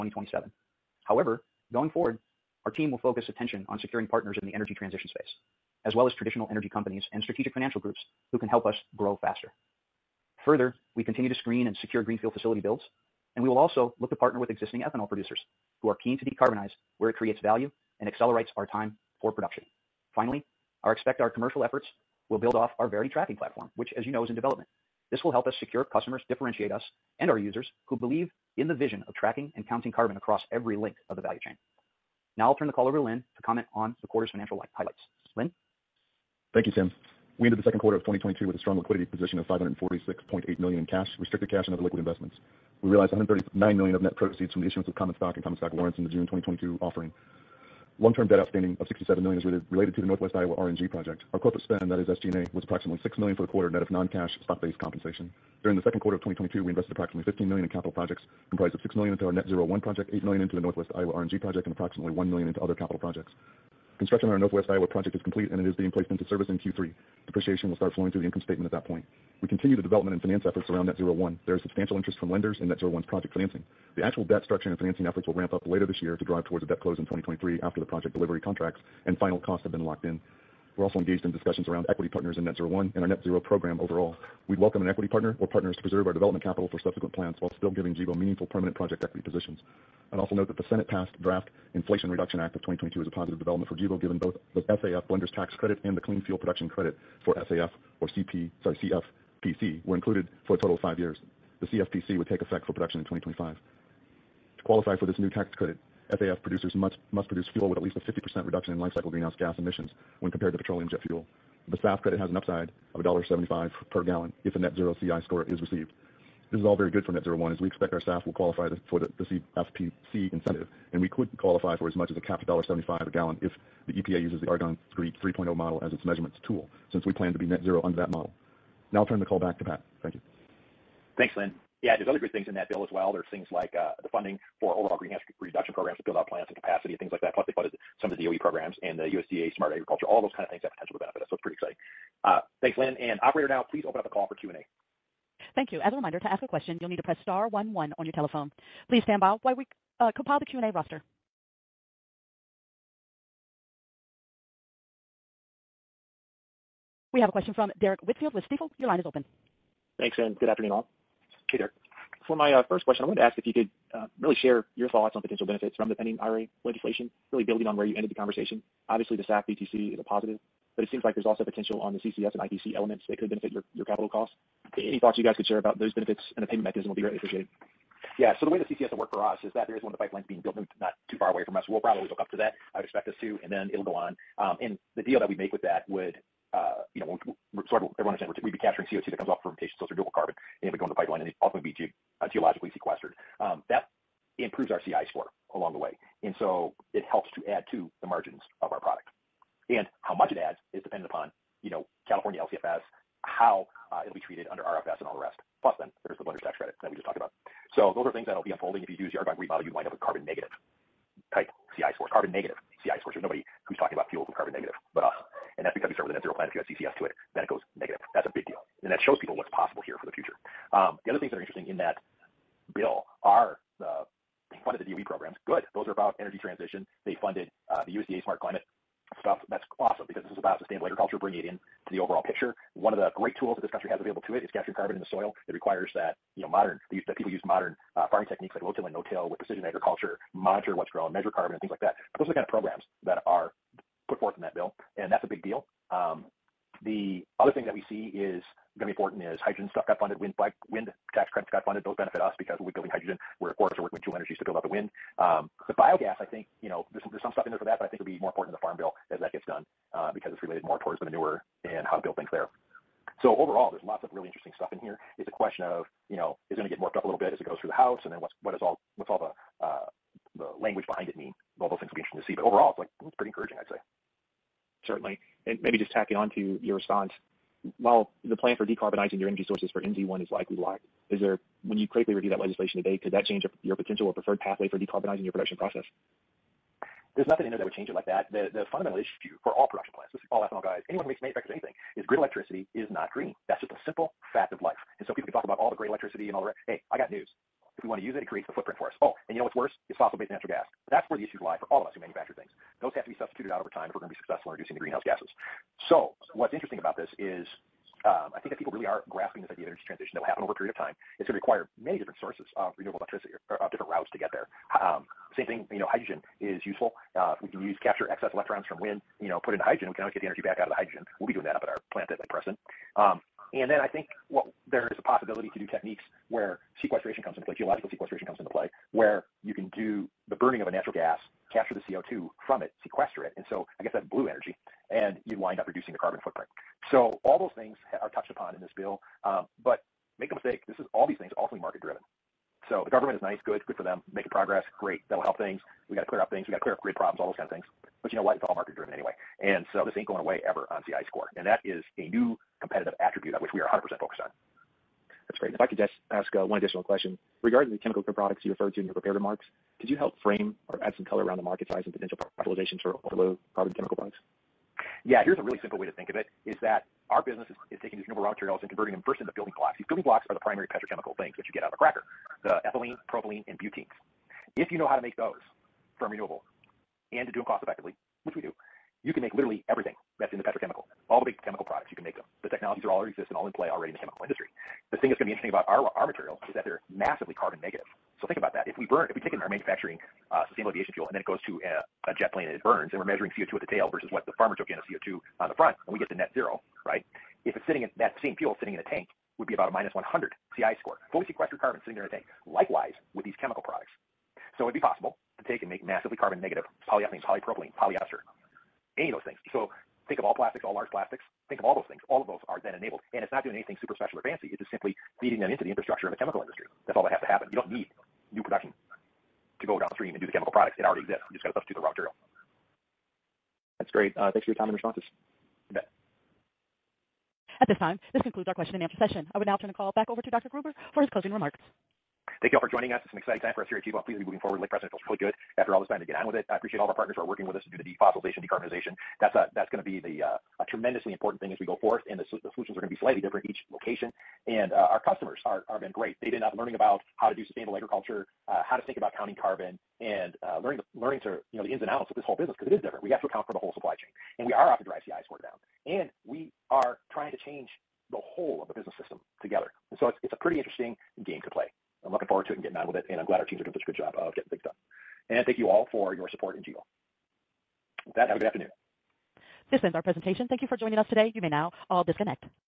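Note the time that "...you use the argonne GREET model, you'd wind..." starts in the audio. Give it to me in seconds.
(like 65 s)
208 s.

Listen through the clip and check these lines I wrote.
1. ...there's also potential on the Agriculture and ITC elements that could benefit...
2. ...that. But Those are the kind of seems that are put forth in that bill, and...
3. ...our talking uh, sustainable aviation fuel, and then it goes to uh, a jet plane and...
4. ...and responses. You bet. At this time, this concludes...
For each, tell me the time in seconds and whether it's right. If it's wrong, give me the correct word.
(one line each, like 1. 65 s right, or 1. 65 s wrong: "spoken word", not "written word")
1. 171 s wrong: "CCS", not "Agriculture"
2. 241 s wrong: "programs", not "seems"
3. 389 s wrong: "manufacturing", not "talking"
4. 424 s right.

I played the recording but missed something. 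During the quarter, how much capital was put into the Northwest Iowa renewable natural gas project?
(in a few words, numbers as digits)
$8 million.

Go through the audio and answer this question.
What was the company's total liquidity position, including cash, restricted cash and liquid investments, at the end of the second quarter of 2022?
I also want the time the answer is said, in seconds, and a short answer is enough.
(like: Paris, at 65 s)
$546.8 million, at 39 s.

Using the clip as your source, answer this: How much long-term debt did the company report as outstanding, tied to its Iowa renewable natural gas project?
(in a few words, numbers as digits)
$67 million.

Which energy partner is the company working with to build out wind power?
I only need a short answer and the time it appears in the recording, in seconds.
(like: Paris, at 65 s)
Juhl Energies, at 254 s.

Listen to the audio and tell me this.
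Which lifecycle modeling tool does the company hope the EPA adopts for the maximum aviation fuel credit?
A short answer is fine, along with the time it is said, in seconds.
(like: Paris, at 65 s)
Argonne GREET 3.0, at 124 s.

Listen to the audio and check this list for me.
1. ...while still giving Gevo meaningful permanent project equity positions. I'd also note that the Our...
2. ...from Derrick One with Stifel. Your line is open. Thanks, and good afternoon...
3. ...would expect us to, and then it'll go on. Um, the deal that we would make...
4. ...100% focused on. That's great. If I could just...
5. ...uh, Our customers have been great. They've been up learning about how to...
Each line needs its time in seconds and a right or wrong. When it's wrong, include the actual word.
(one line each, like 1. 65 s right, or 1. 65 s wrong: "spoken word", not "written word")
1. 87 s wrong: "Senate", not "Our"
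2. 157 s wrong: "Whitfield", not "One"
3. 182 s right
4. 353 s right
5. 444 s right.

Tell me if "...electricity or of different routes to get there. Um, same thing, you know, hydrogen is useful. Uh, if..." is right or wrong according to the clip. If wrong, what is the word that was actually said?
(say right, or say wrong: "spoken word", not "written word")
right.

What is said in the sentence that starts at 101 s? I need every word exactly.
The CFPC would take effect for production in 2025.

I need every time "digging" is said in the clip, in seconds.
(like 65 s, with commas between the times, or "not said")
not said.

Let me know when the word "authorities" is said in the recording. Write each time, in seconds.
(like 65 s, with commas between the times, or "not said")
not said.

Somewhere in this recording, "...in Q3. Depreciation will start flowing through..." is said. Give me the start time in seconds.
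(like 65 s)
66 s.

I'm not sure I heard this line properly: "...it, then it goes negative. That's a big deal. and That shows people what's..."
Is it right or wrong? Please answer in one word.
right.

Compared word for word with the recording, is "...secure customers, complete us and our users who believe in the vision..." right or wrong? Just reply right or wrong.
wrong.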